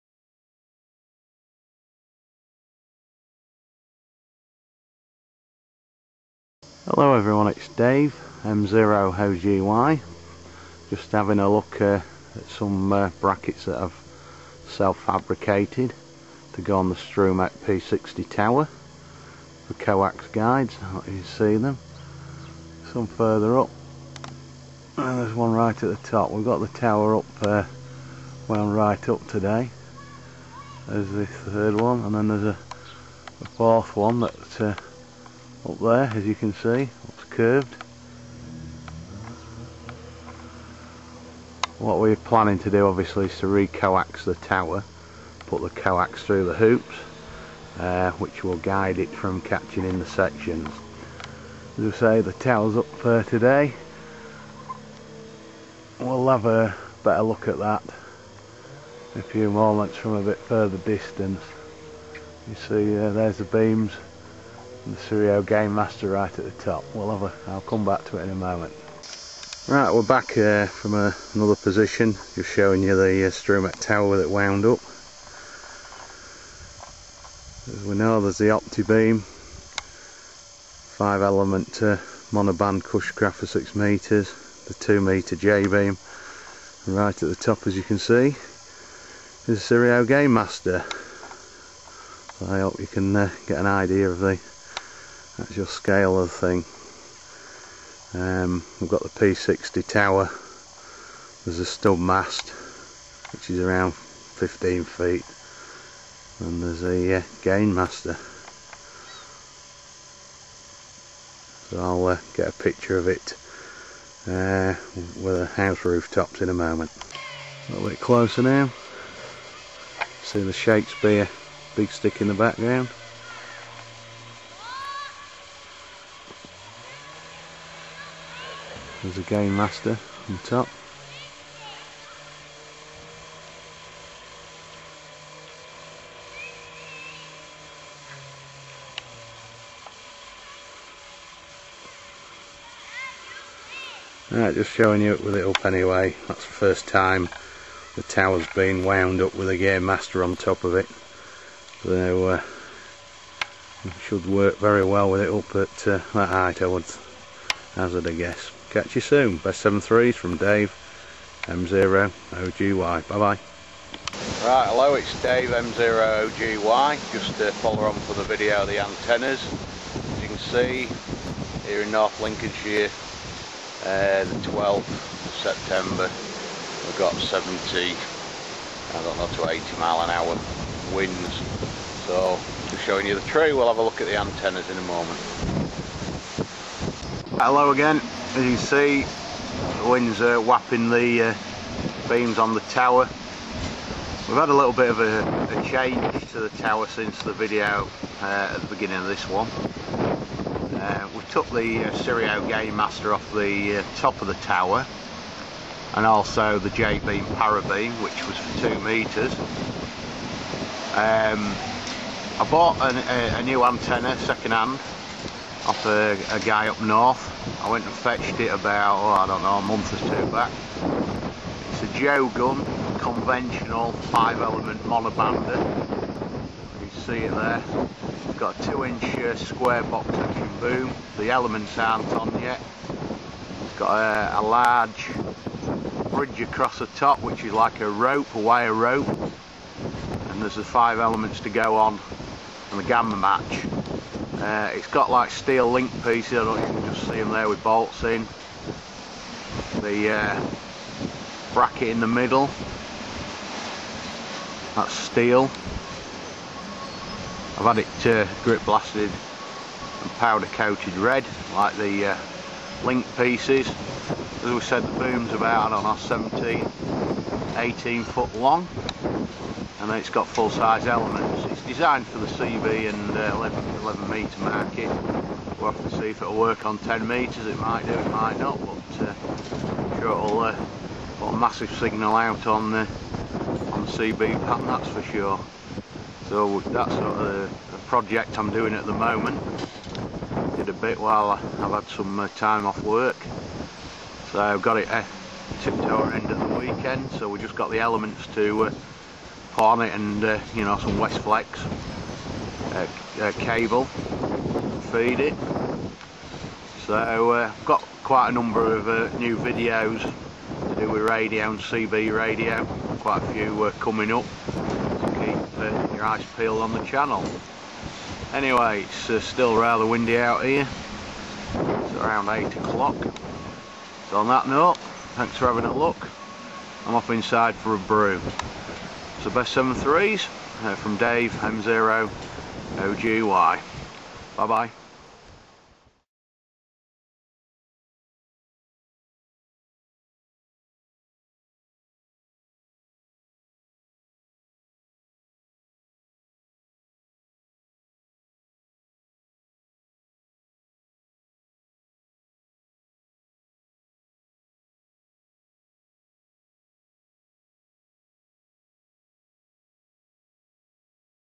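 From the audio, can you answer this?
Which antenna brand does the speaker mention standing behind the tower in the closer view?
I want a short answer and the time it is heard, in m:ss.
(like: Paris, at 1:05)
Shakespeare big stick, at 2:00.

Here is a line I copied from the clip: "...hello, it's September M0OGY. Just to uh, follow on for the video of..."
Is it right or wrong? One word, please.
wrong.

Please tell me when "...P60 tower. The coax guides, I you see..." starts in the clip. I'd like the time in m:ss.
0:17.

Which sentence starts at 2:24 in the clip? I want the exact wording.
Right, just showing you it with it up anyway.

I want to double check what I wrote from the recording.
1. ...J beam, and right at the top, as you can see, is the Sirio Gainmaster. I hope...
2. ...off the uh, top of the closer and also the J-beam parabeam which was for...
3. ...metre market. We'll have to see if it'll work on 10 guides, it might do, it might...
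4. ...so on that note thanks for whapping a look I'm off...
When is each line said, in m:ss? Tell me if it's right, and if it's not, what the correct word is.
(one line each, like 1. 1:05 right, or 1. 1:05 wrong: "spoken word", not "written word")
1. 1:25 right
2. 3:23 wrong: "tower", not "closer"
3. 4:34 wrong: "metres", not "guides"
4. 5:24 wrong: "having", not "whapping".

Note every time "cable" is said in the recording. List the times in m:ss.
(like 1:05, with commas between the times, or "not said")
5:03.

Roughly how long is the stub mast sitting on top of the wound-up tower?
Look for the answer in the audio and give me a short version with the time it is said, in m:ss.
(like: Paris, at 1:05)
15 feet, at 1:43.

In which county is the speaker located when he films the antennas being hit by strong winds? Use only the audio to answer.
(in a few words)
North Lincolnshire.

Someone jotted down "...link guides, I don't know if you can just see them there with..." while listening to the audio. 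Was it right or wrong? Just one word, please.
wrong.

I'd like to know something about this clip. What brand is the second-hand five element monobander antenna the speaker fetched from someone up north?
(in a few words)
Jogunn.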